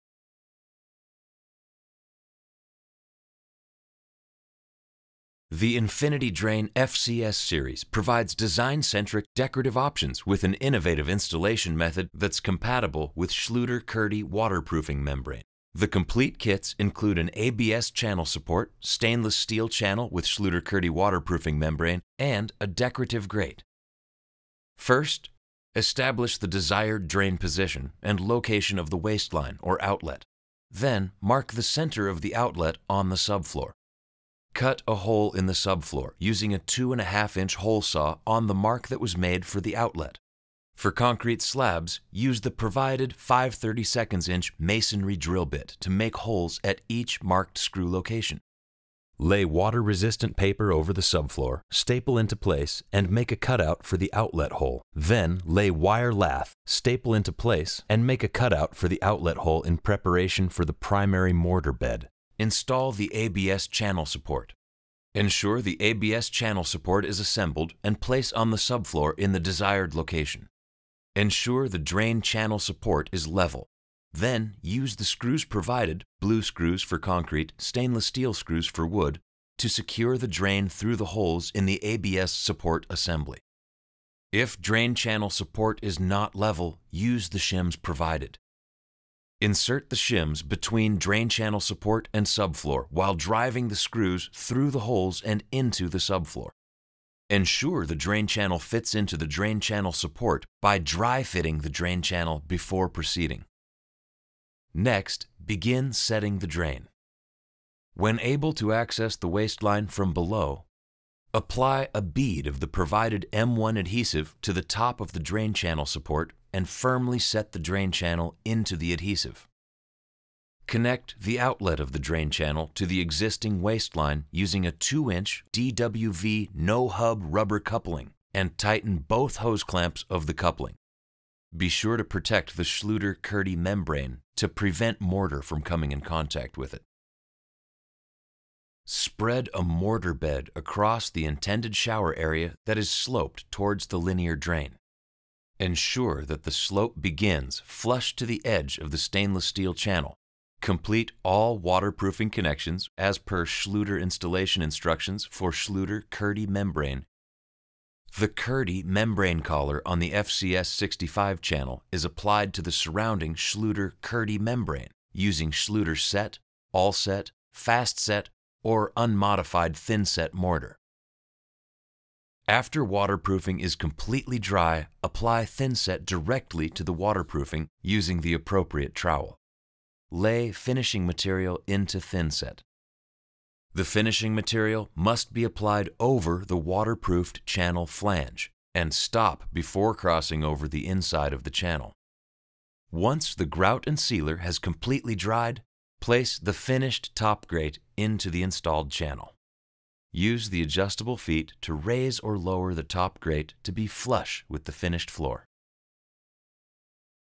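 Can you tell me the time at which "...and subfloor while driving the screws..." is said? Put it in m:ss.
1:32.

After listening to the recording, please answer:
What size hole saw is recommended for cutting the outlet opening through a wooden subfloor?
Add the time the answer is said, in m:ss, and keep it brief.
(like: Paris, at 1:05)
2.5 inch, at 0:36.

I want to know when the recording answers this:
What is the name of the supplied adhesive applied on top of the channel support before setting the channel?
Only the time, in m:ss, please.
1:53.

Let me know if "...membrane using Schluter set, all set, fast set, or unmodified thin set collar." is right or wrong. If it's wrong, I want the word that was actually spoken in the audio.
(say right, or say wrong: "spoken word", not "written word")
wrong: "mortar", not "collar".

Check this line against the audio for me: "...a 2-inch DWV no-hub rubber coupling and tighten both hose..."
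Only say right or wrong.
right.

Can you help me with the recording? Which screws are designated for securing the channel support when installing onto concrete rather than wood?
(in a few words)
blue screws.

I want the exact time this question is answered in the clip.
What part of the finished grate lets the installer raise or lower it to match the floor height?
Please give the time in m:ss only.
3:20.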